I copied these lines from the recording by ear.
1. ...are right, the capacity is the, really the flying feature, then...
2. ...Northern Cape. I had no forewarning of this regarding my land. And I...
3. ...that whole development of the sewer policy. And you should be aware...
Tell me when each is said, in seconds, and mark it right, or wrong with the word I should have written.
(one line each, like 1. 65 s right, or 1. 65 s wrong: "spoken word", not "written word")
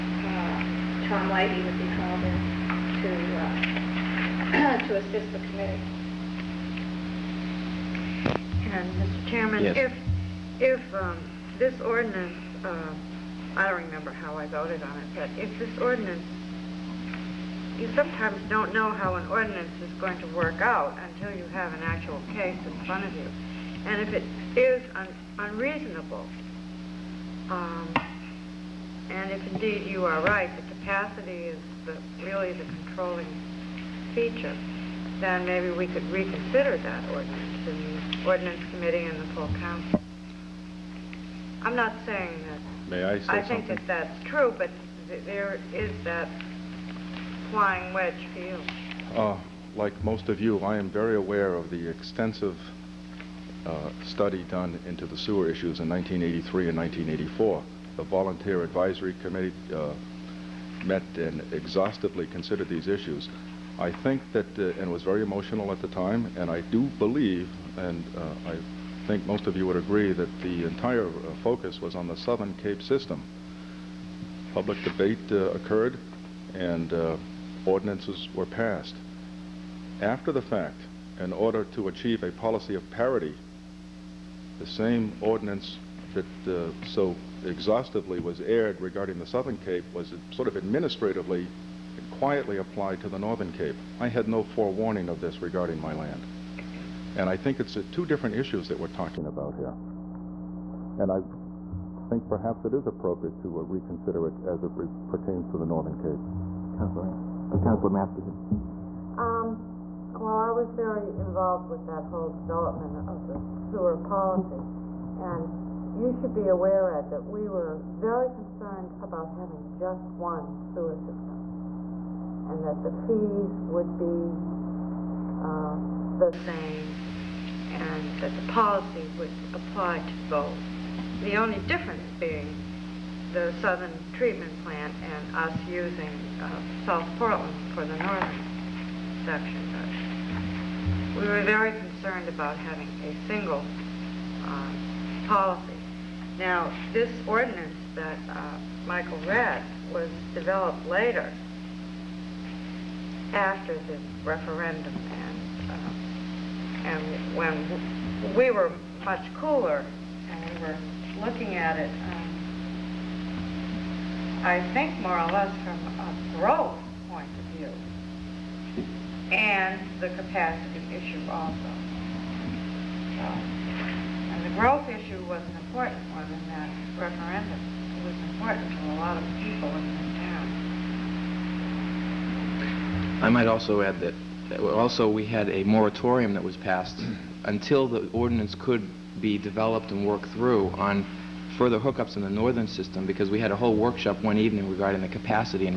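1. 30 s wrong: "controlling", not "flying"
2. 93 s right
3. 111 s right.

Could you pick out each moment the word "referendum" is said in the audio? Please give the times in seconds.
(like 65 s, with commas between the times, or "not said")
154 s, 176 s.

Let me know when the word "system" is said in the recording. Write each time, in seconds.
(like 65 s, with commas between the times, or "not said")
72 s, 120 s, 192 s.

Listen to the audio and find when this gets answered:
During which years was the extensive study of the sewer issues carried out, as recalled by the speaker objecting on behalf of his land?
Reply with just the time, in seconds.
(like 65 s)
55 s.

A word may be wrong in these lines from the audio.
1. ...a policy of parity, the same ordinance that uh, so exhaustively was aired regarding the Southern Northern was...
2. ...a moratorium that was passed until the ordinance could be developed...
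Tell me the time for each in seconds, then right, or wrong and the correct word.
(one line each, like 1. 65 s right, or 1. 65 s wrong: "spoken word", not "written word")
1. 82 s wrong: "Cape", not "Northern"
2. 185 s right.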